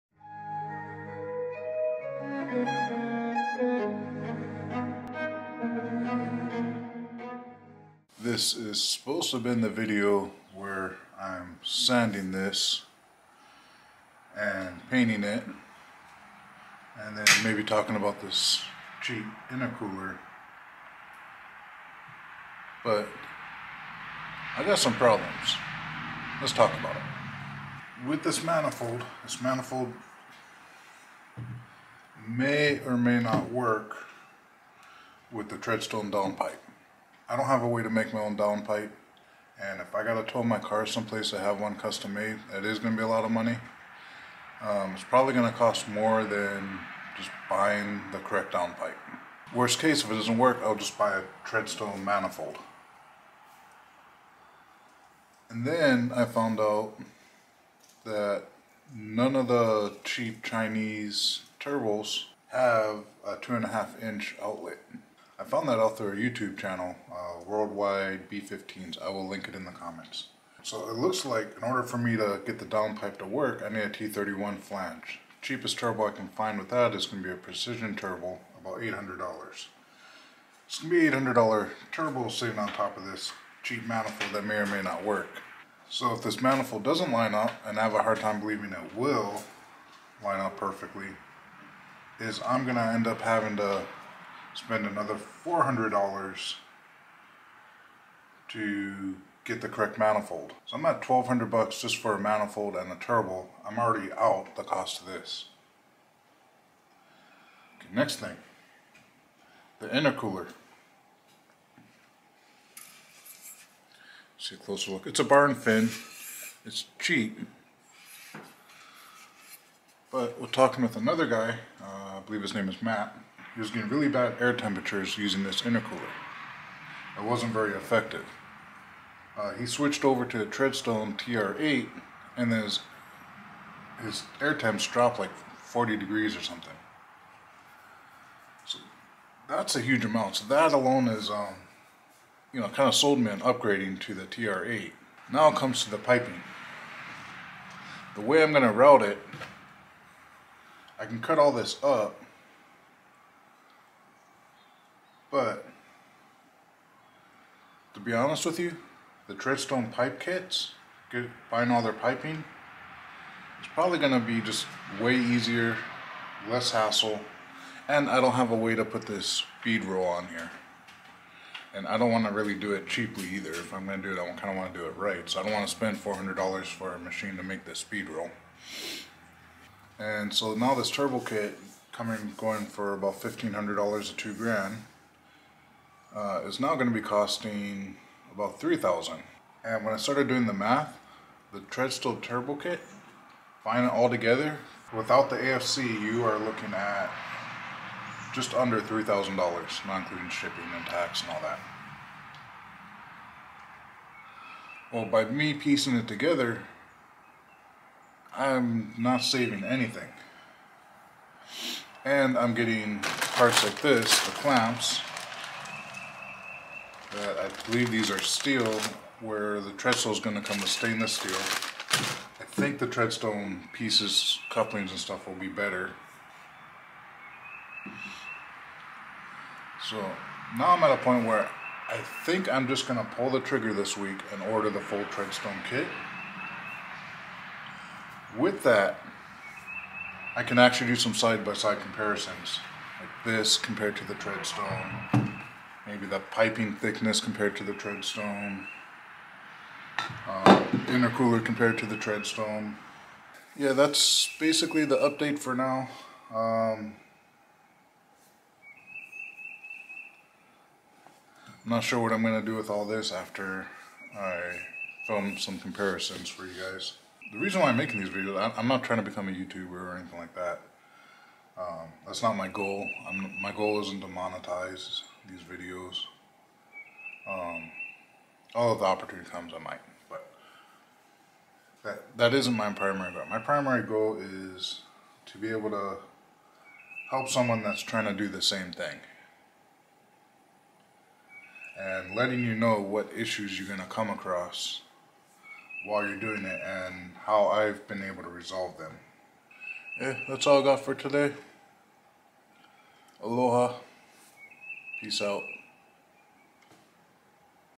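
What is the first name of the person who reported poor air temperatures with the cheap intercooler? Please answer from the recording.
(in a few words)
Matt.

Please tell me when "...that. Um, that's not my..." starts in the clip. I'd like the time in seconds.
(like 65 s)
270 s.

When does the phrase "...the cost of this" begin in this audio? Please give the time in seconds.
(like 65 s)
104 s.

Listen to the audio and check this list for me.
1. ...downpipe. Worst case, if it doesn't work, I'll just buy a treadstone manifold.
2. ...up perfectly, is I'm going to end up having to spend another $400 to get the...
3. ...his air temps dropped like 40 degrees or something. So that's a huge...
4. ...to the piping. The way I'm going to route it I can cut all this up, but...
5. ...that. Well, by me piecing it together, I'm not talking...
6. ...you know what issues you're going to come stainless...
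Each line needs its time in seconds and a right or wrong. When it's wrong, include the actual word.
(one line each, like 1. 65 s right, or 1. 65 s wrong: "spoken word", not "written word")
1. 48 s right
2. 90 s right
3. 134 s right
4. 145 s right
5. 201 s wrong: "saving", not "talking"
6. 292 s wrong: "across", not "stainless".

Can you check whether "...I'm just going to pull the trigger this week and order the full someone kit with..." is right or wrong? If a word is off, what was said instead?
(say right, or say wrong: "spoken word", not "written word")
wrong: "treadstone", not "someone".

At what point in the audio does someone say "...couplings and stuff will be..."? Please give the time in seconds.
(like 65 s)
224 s.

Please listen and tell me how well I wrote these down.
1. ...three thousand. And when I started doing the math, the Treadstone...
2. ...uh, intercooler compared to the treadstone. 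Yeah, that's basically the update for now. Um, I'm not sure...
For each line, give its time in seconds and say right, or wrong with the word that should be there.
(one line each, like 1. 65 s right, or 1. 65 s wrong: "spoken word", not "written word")
1. 188 s right
2. 250 s right.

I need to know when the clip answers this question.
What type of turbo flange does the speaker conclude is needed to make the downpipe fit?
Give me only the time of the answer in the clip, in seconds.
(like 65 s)
73 s.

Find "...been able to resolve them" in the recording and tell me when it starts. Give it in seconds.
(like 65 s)
297 s.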